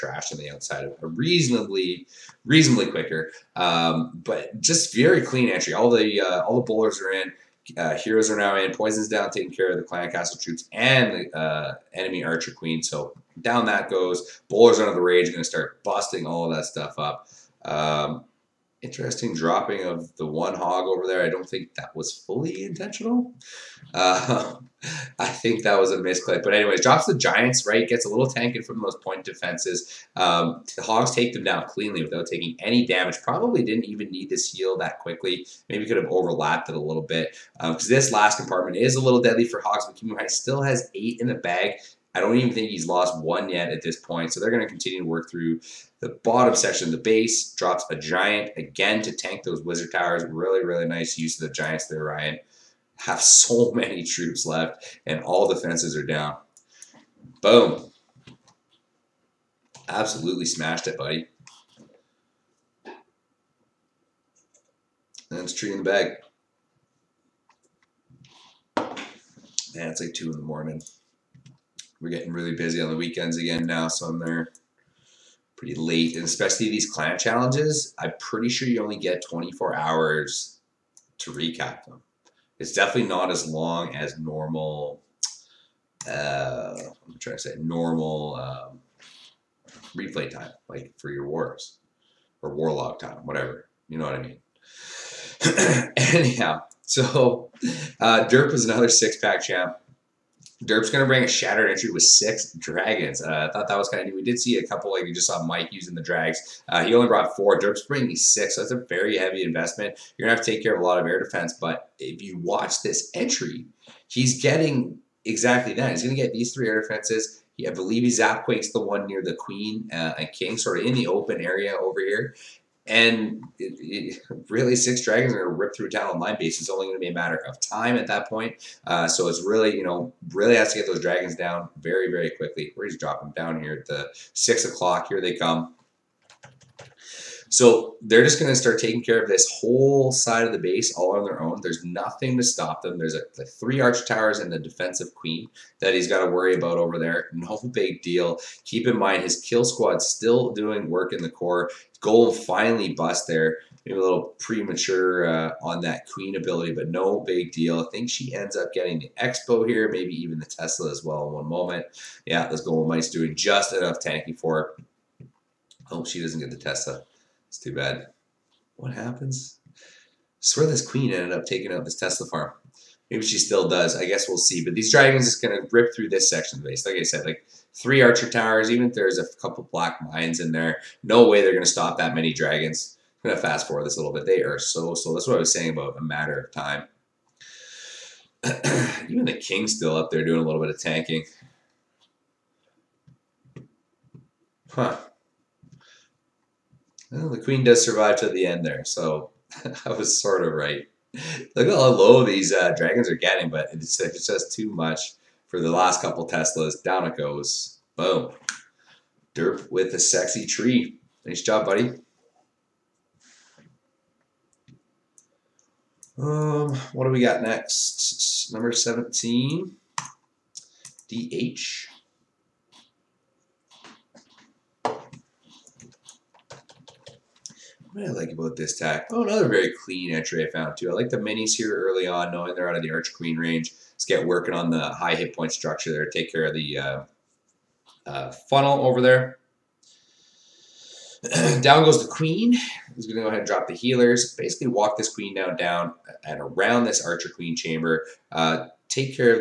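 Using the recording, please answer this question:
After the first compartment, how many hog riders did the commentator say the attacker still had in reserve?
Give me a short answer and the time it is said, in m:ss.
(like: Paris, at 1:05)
8, at 0:40.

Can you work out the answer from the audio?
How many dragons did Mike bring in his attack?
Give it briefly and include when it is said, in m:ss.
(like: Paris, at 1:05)
4, at 1:47.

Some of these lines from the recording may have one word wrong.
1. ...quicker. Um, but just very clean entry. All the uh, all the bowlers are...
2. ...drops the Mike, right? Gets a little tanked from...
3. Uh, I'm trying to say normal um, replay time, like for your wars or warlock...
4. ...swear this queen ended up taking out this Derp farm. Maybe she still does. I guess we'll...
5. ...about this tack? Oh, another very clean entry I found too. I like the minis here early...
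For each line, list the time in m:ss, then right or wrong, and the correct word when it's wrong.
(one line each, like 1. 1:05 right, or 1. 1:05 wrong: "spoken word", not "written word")
1. 0:02 right
2. 0:26 wrong: "Giants", not "Mike"
3. 1:26 right
4. 2:50 wrong: "Tesla", not "Derp"
5. 3:48 right.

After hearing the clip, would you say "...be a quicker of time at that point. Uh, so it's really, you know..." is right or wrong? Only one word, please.
wrong.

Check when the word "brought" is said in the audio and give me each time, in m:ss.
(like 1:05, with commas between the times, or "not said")
1:47.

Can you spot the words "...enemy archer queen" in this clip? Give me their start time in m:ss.
0:11.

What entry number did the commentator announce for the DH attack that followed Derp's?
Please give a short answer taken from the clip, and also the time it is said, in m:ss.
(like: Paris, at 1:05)
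17, at 3:38.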